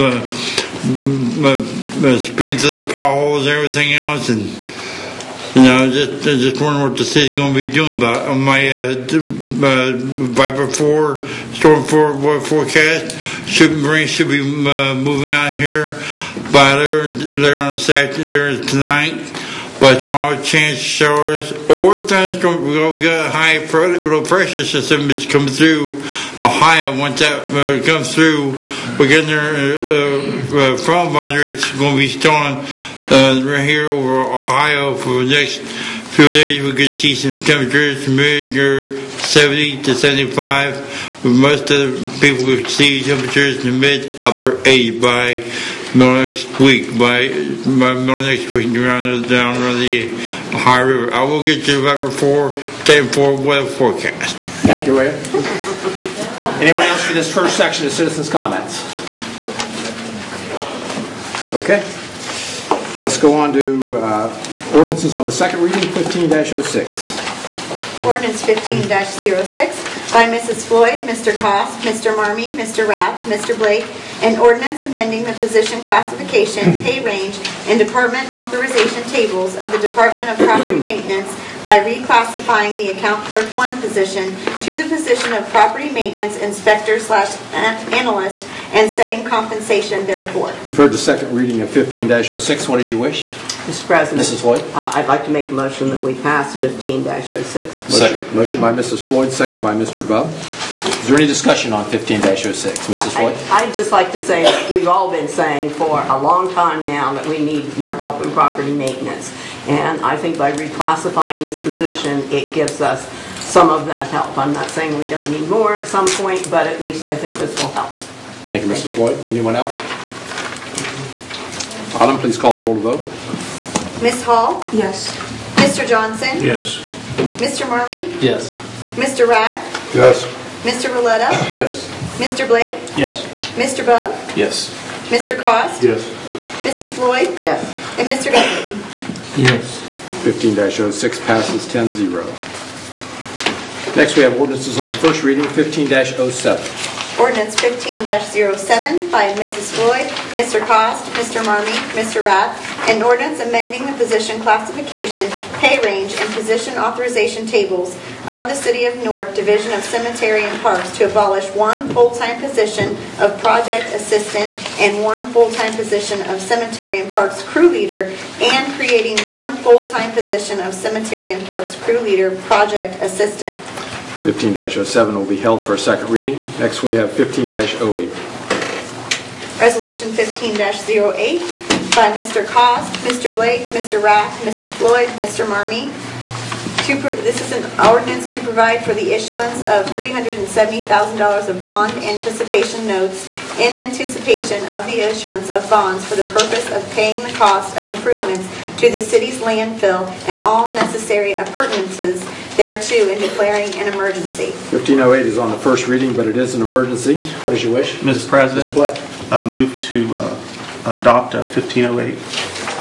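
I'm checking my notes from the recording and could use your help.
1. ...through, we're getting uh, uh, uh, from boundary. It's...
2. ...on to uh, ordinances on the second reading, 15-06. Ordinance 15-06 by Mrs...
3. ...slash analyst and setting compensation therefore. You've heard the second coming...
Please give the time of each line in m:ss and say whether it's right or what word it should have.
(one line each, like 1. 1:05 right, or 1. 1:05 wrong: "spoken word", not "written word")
1. 0:28 right
2. 1:03 right
3. 1:26 wrong: "reading", not "coming".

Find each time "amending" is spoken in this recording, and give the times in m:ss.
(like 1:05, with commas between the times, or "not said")
1:14, 2:33.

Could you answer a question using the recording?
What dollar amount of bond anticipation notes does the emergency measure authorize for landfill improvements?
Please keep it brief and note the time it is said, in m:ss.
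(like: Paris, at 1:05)
$370,000, at 3:09.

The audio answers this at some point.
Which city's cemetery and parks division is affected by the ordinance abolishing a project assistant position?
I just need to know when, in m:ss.
2:39.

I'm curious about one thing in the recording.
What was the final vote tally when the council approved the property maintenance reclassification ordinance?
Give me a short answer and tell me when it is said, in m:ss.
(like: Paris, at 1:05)
10-0, at 2:21.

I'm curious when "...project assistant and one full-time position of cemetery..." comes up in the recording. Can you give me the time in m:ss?
2:43.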